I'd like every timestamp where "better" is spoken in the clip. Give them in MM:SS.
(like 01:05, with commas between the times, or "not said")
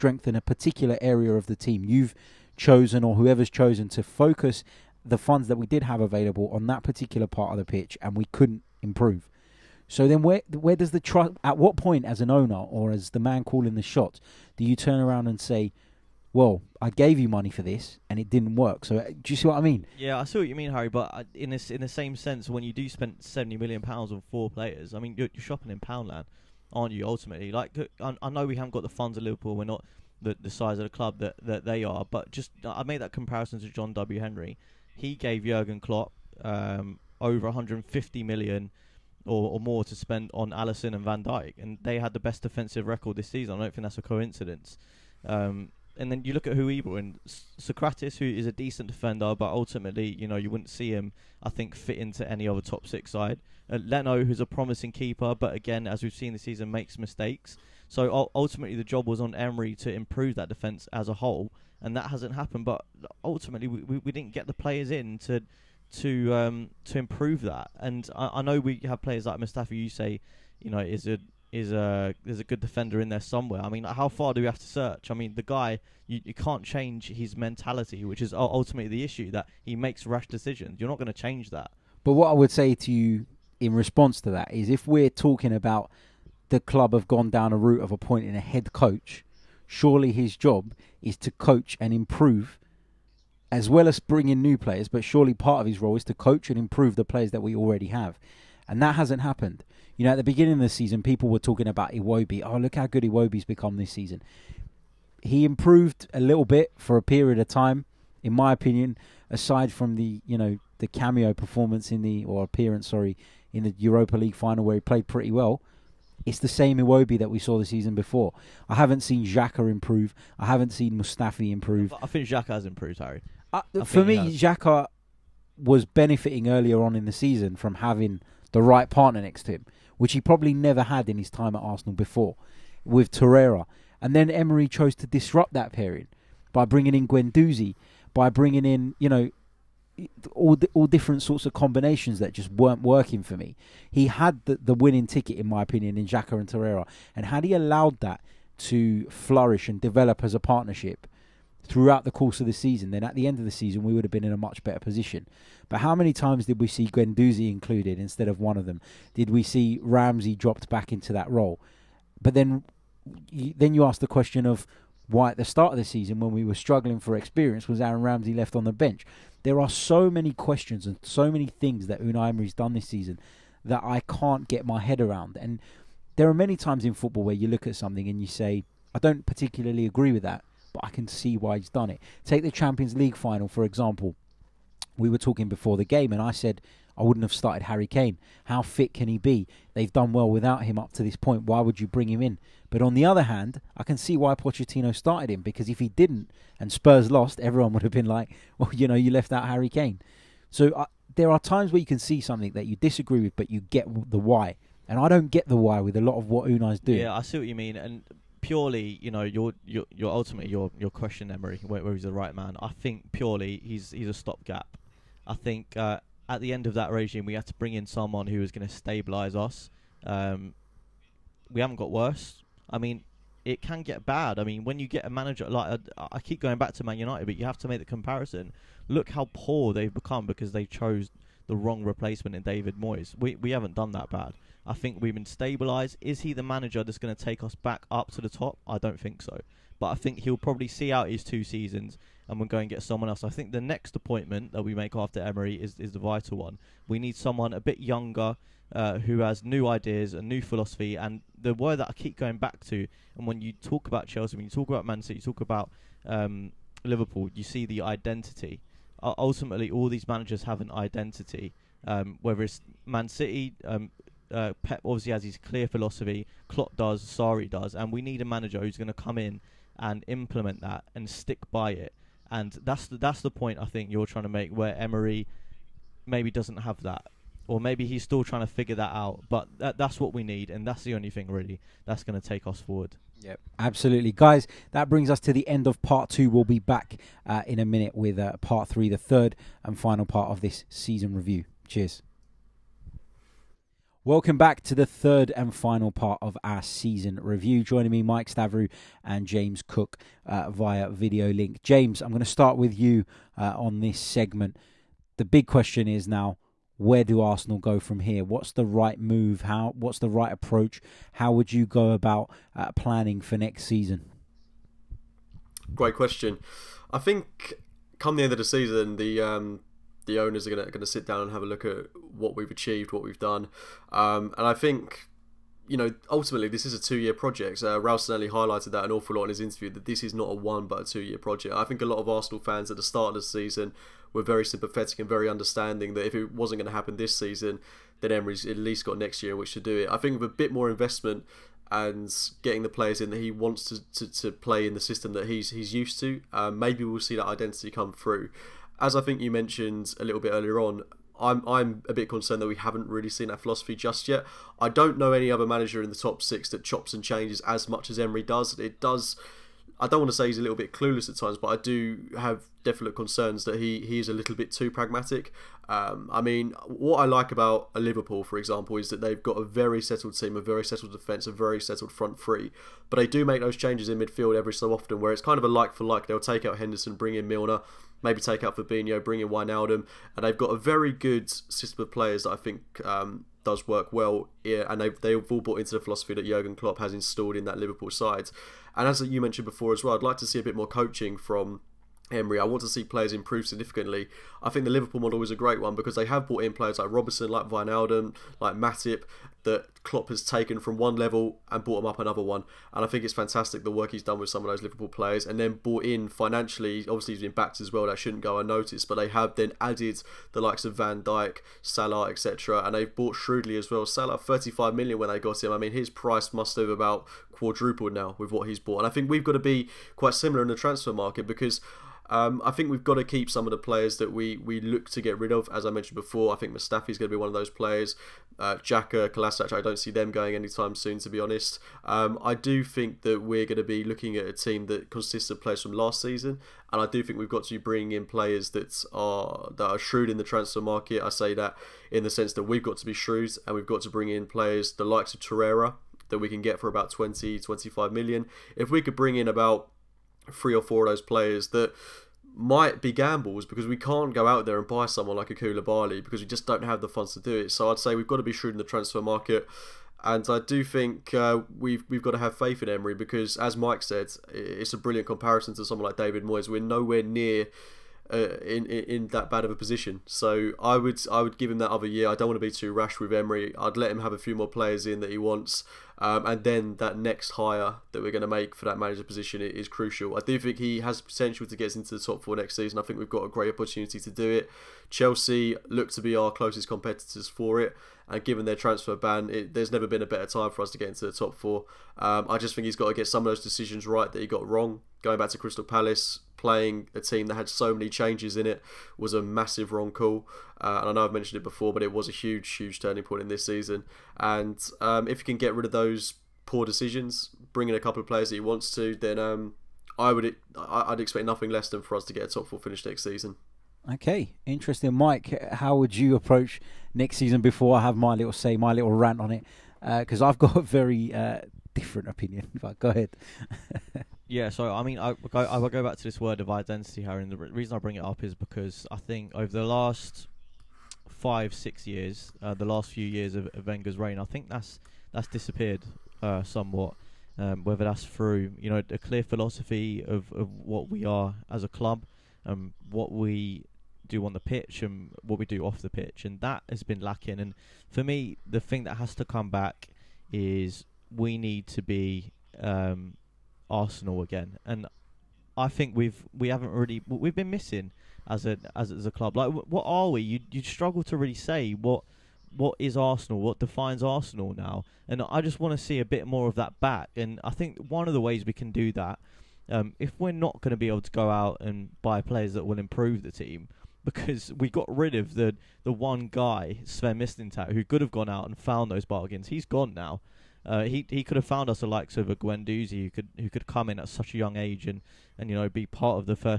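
02:34, 08:10.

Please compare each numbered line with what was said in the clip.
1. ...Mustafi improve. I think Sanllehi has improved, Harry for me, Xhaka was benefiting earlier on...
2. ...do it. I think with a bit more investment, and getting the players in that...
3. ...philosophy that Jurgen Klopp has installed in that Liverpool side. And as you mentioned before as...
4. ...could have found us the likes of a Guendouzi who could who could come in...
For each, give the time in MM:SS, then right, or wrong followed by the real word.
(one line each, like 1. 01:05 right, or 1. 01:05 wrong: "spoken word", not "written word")
1. 02:00 wrong: "Xhaka", not "Sanllehi"
2. 05:39 right
3. 06:25 right
4. 09:41 right.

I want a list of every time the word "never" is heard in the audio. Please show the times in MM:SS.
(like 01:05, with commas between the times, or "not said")
02:10, 08:09.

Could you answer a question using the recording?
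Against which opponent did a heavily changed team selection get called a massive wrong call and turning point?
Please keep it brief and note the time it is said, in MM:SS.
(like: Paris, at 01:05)
Crystal Palace, at 08:15.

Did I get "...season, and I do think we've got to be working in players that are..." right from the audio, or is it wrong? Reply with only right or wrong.
wrong.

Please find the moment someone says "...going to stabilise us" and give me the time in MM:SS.
03:38.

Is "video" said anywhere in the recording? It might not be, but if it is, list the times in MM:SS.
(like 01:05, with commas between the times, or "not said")
05:00.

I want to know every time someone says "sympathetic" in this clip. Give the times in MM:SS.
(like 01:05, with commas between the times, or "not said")
05:34.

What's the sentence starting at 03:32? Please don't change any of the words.
I think purely he's he's a stopgap.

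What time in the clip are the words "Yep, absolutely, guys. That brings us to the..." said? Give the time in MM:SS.
04:43.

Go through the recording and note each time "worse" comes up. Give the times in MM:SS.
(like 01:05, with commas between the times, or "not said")
03:41.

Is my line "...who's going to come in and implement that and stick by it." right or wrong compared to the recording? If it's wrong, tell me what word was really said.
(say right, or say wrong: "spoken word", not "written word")
right.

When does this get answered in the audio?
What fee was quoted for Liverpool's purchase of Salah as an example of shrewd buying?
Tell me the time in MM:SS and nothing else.
06:54.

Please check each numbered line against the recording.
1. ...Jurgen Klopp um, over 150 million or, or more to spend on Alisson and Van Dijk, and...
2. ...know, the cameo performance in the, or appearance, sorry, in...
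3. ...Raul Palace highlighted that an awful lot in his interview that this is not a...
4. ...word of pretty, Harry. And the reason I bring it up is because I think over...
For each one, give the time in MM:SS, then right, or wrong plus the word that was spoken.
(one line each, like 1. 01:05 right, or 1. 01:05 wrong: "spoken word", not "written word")
1. 00:35 right
2. 01:50 right
3. 05:27 wrong: "Sanllehi", not "Palace"
4. 08:46 wrong: "identity", not "pretty".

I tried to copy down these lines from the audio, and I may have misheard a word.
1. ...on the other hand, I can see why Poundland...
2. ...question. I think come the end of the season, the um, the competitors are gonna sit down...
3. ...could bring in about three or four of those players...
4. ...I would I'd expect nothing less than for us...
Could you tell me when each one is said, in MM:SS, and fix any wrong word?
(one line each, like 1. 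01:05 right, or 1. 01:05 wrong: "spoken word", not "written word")
1. 03:12 wrong: "Pochettino", not "Poundland"
2. 05:15 wrong: "owners", not "competitors"
3. 07:28 right
4. 08:29 right.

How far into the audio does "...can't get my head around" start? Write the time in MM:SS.
02:54.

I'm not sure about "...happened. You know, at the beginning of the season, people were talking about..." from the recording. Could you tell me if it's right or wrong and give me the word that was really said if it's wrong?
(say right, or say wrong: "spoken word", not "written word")
right.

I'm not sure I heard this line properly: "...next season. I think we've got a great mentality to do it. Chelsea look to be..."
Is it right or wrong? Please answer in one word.
wrong.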